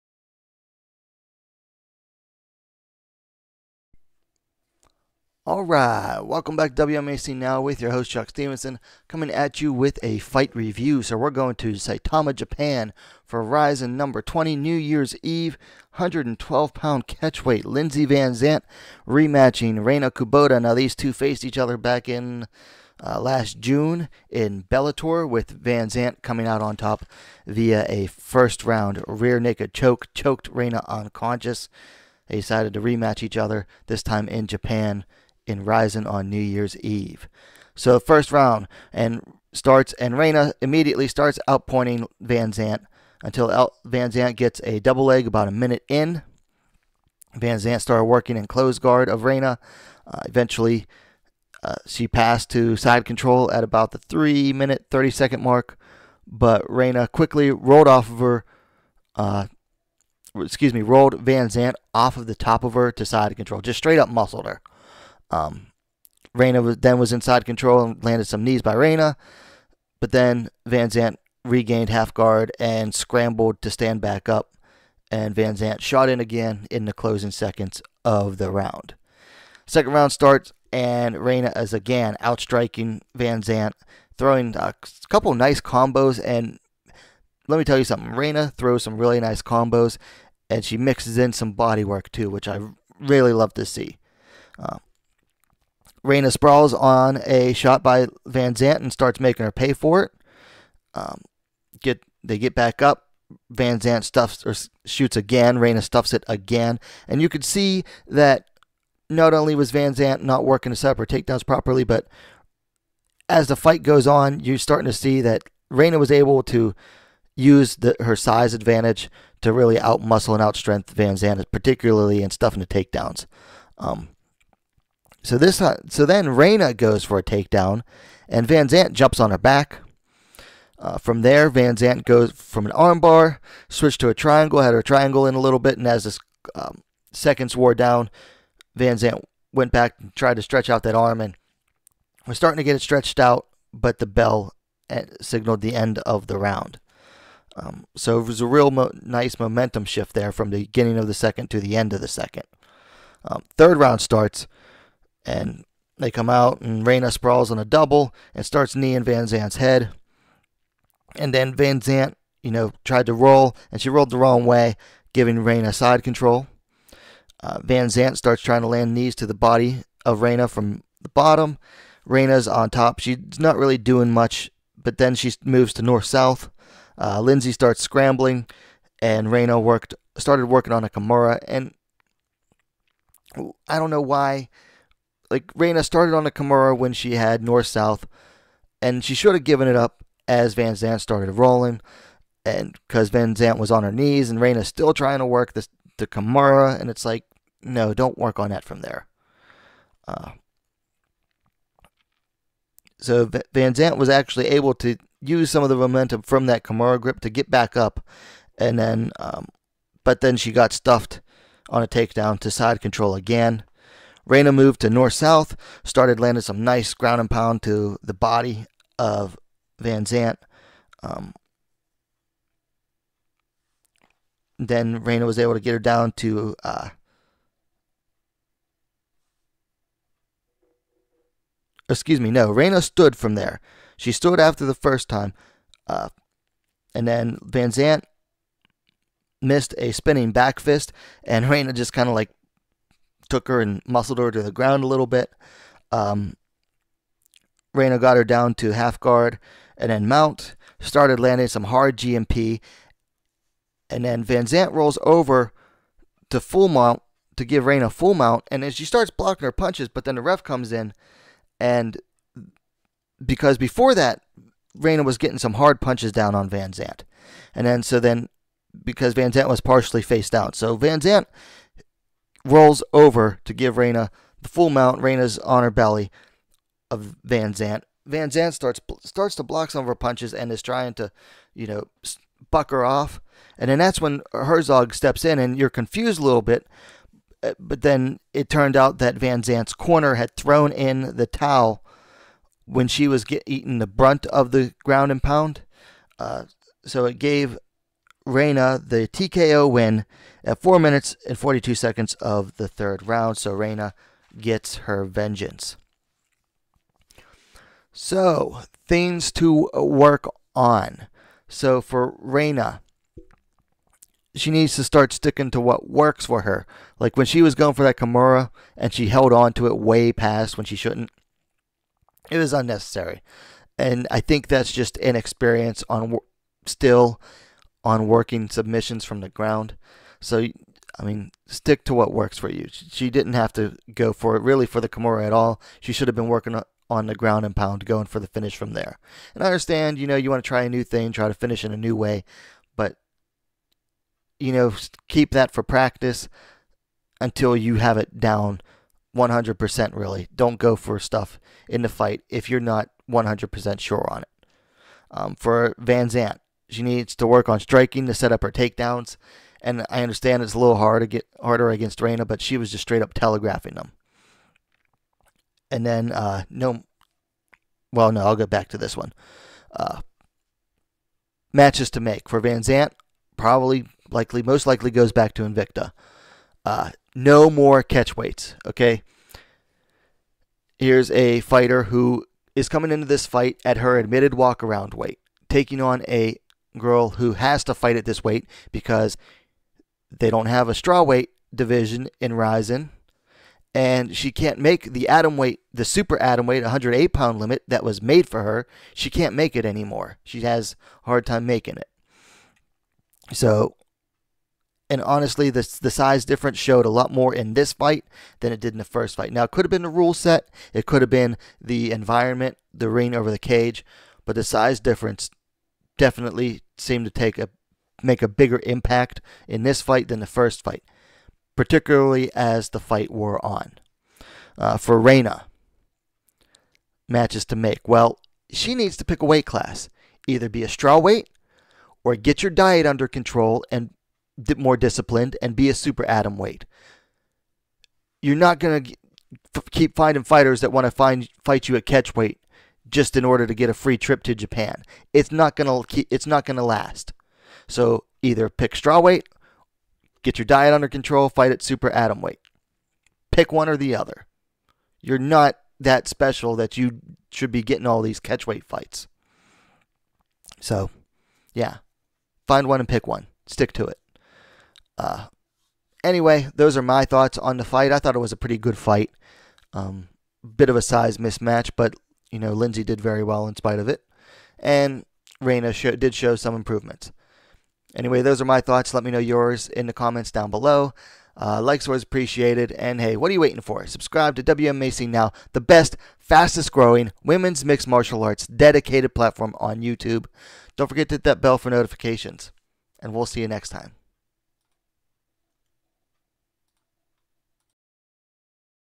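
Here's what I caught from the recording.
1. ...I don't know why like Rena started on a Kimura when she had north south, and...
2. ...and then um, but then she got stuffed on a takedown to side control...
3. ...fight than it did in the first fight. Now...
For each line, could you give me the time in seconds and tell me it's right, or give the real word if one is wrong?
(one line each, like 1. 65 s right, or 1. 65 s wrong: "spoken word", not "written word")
1. 183 s right
2. 208 s right
3. 407 s right.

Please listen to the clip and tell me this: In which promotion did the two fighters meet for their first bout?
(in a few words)
Bellator.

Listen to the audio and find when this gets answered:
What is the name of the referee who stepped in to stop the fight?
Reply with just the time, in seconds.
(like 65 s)
284 s.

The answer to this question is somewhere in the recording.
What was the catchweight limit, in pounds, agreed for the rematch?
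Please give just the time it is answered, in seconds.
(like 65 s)
15 s.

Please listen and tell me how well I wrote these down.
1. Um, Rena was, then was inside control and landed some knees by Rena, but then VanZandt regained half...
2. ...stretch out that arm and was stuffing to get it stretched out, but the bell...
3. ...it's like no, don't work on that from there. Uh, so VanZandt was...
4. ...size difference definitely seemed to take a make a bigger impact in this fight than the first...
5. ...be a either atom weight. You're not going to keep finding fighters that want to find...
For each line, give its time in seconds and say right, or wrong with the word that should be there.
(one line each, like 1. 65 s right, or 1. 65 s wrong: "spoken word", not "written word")
1. 65 s right
2. 140 s wrong: "starting", not "stuffing"
3. 196 s right
4. 414 s right
5. 435 s wrong: "super", not "either".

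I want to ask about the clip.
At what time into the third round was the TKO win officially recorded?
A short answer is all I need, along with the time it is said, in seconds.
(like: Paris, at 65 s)
4:42, at 300 s.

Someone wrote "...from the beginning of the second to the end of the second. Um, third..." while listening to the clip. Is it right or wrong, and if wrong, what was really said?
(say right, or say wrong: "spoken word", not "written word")
right.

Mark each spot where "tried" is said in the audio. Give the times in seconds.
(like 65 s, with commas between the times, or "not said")
140 s, 162 s.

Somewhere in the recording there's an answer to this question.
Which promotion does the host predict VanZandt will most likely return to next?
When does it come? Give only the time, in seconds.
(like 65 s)
375 s.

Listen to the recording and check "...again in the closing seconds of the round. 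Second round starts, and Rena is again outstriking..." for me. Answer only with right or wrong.
right.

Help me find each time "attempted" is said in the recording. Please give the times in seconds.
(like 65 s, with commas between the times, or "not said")
not said.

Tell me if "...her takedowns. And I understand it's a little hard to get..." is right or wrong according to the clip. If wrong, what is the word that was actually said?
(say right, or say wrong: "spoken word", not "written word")
right.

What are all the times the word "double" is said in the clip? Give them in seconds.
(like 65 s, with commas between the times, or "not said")
44 s, 157 s.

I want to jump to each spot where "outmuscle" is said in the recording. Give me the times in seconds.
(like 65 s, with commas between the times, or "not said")
119 s.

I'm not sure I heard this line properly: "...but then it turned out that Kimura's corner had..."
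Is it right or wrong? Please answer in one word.
wrong.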